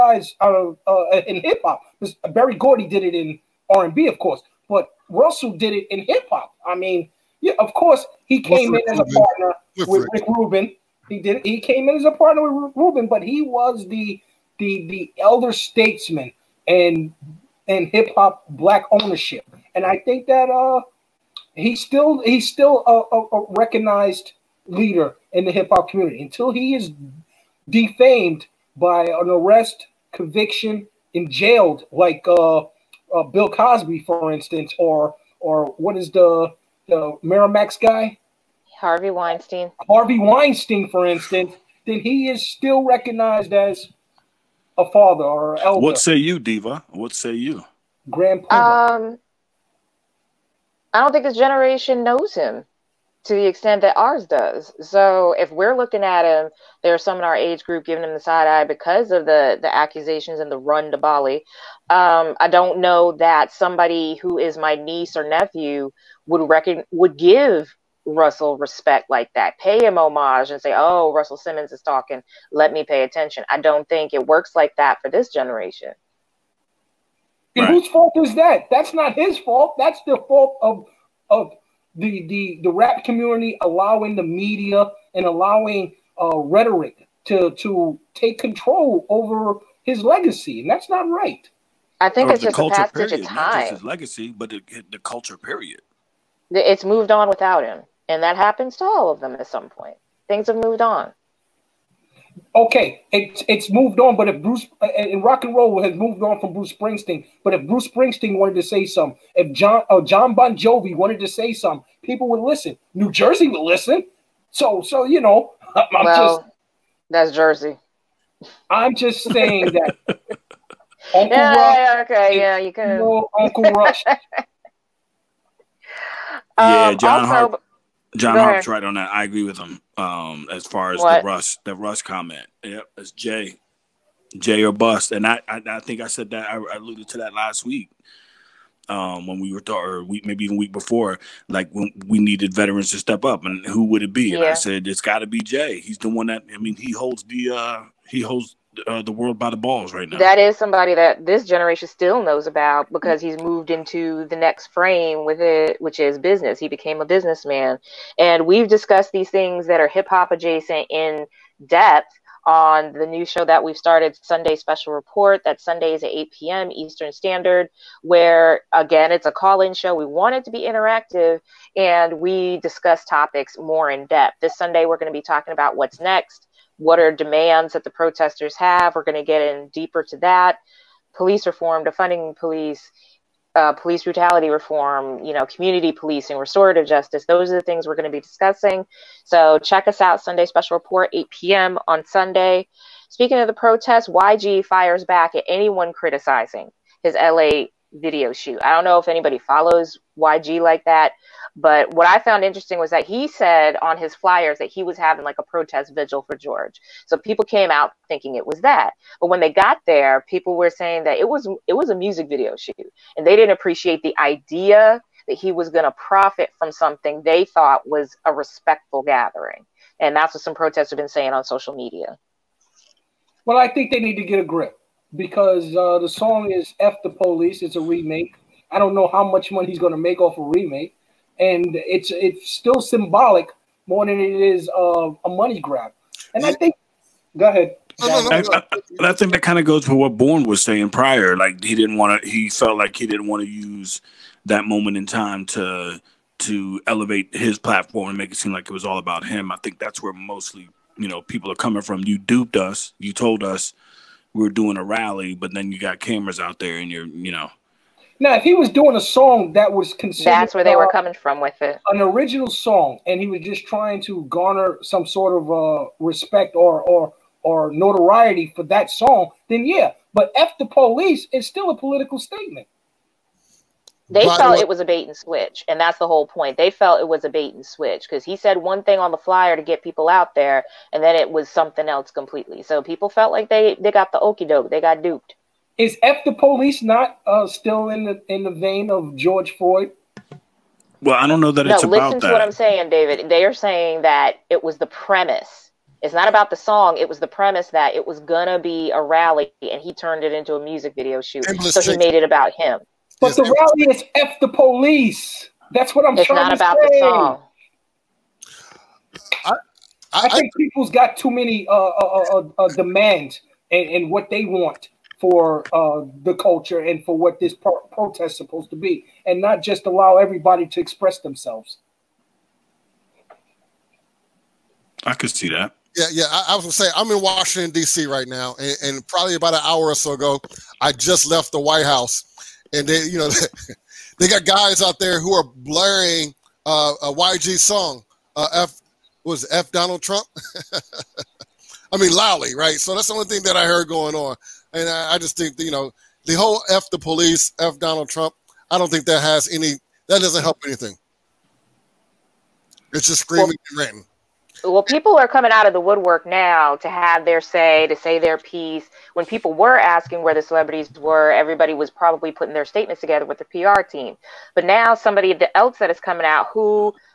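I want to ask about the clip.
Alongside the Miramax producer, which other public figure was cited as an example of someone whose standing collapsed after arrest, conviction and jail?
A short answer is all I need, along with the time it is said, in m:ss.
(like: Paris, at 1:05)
Bill Cosby, at 0:33.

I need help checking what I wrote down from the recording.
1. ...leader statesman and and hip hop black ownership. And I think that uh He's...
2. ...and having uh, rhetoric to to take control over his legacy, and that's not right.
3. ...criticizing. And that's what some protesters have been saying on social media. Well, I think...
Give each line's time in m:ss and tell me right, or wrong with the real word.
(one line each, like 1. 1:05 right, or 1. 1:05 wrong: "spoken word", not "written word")
1. 0:15 wrong: "elder", not "leader"
2. 1:25 wrong: "allowing", not "having"
3. 3:39 wrong: "gathering", not "criticizing".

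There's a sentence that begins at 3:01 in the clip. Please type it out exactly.
Police reform, defunding police, uh, police brutality reform, you know, community policing, restorative justice.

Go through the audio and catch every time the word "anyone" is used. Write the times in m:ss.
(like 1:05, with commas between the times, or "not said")
3:15.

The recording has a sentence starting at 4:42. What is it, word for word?
So people felt like they they got the okey doke, they got duped.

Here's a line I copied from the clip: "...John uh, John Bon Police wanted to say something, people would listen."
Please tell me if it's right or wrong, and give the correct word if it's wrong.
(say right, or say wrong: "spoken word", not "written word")
wrong: "Jovi", not "Police".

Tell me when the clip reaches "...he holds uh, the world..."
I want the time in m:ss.
2:28.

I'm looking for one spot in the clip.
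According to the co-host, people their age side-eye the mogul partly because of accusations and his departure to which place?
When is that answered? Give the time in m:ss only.
1:00.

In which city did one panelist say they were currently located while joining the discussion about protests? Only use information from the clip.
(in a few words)
Washington D.C.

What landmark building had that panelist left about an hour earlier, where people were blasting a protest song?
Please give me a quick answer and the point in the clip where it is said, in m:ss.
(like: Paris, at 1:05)
The White House, at 5:31.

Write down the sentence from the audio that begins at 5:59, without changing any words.
When people were asking where the celebrities were, everybody was probably putting their statements together with the PR team.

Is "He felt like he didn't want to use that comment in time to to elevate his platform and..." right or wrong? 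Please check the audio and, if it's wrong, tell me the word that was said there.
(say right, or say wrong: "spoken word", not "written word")
wrong: "moment", not "comment".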